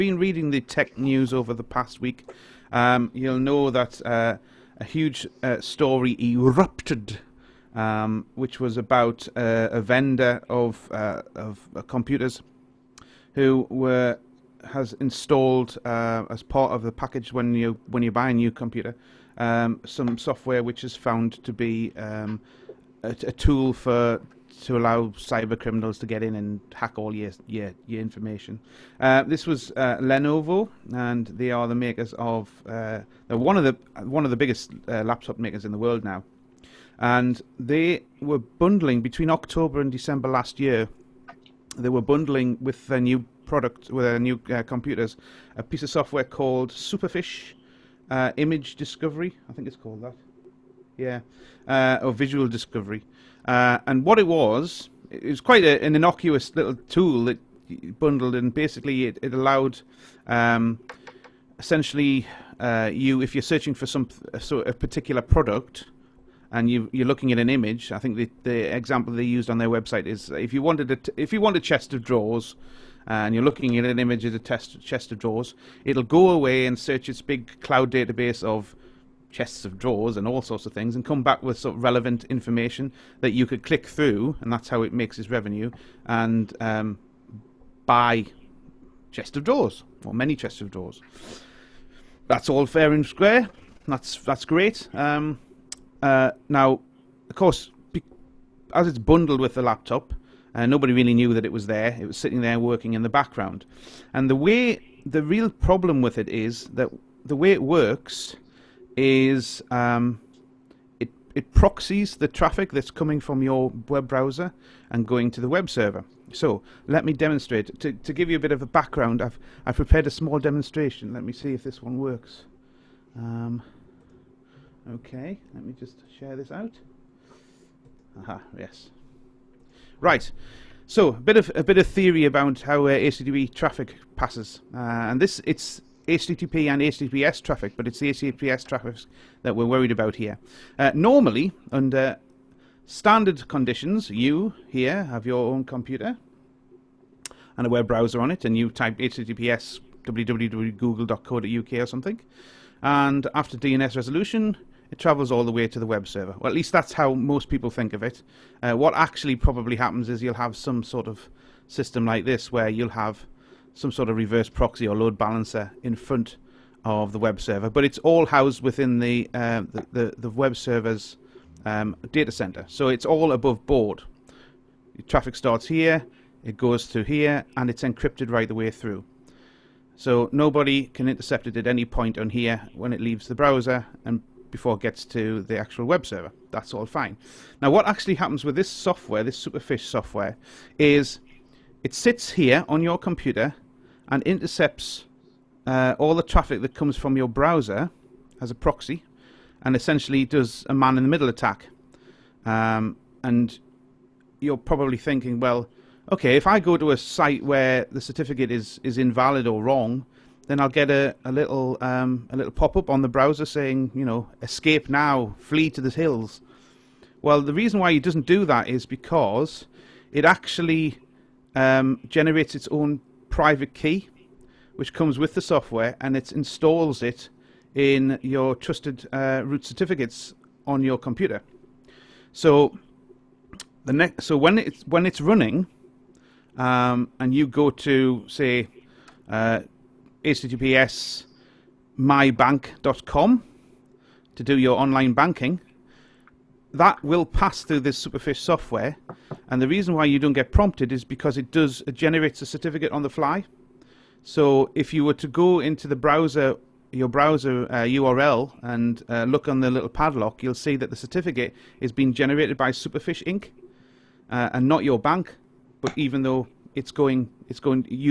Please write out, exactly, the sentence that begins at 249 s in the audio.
And the reason why you don't get prompted is because it does it generates a certificate on the fly.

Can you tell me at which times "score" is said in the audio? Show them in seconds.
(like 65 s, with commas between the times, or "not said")
not said.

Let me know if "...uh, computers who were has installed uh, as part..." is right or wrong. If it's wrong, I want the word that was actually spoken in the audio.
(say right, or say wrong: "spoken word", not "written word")
right.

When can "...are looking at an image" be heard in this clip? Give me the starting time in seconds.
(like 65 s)
66 s.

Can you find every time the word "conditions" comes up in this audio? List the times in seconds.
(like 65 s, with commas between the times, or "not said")
143 s.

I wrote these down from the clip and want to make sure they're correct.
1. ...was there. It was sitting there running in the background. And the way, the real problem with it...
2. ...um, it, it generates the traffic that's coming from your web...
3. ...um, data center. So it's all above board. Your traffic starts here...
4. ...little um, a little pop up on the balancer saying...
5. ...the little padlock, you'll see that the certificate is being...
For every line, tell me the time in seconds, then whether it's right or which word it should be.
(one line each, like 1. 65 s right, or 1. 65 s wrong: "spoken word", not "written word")
1. 101 s wrong: "working", not "running"
2. 109 s wrong: "proxies", not "generates"
3. 171 s right
4. 211 s wrong: "browser", not "balancer"
5. 259 s right.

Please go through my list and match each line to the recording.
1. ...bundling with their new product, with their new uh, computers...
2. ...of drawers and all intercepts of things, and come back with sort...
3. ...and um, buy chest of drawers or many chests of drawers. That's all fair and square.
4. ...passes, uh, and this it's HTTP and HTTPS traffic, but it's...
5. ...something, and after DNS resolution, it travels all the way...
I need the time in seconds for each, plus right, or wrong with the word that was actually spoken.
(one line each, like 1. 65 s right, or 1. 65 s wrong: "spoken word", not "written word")
1. 42 s right
2. 79 s wrong: "sorts", not "intercepts"
3. 86 s right
4. 134 s right
5. 151 s right.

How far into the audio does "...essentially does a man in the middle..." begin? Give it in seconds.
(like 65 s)
199 s.